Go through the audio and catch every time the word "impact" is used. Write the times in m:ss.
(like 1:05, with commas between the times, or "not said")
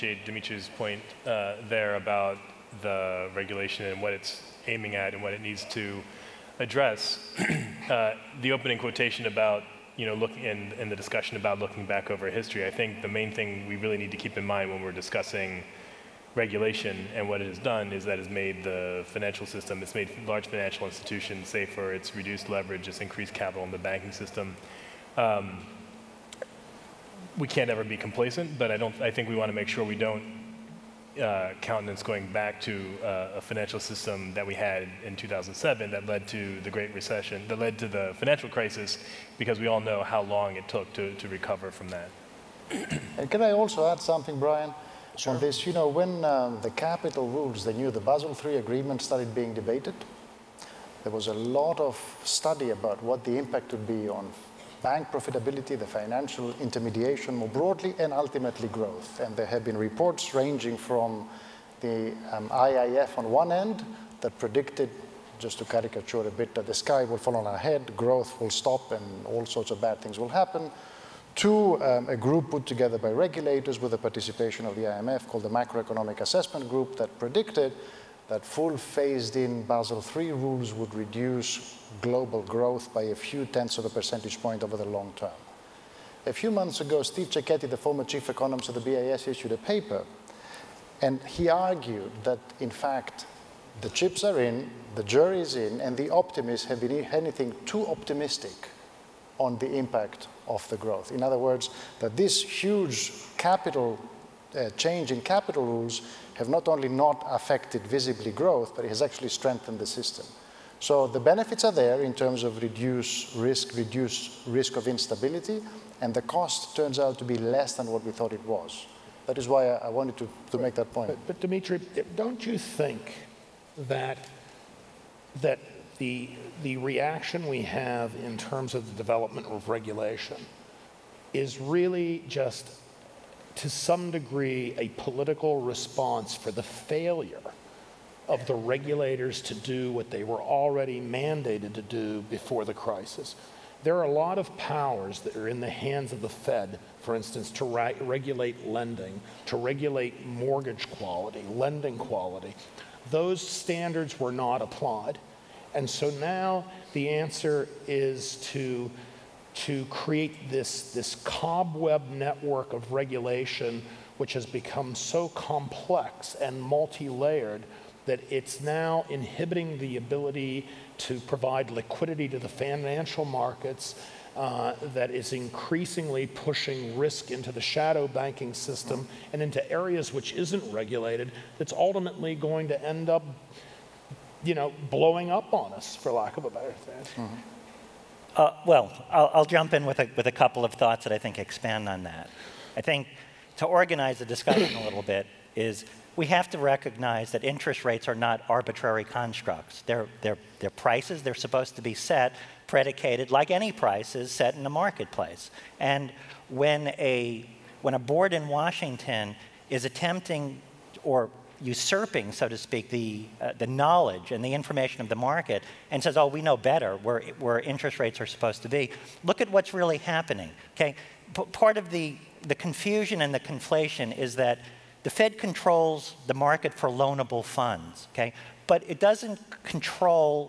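0:53, 1:39.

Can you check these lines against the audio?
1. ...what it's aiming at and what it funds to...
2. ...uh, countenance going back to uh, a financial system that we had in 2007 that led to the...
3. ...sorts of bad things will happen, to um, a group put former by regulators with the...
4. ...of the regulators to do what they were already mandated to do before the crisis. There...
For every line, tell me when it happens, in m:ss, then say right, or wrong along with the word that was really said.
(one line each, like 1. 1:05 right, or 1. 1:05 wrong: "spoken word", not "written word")
1. 0:04 wrong: "needs", not "funds"
2. 0:31 right
3. 1:09 wrong: "together", not "former"
4. 2:18 right.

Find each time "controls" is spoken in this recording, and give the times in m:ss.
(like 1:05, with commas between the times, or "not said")
3:45, 3:49.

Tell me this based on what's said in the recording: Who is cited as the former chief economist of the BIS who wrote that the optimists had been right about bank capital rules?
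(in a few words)
Steve Cecchetti.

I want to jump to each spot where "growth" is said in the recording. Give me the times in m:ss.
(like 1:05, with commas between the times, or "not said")
0:58, 1:07, 1:22, 1:40, 1:48.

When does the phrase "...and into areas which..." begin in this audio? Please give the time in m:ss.
2:59.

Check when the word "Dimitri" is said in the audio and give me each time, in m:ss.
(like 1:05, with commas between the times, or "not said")
0:00, 2:01.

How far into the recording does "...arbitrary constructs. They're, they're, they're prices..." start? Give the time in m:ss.
3:18.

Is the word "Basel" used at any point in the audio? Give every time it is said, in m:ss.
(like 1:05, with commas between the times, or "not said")
0:48, 1:19.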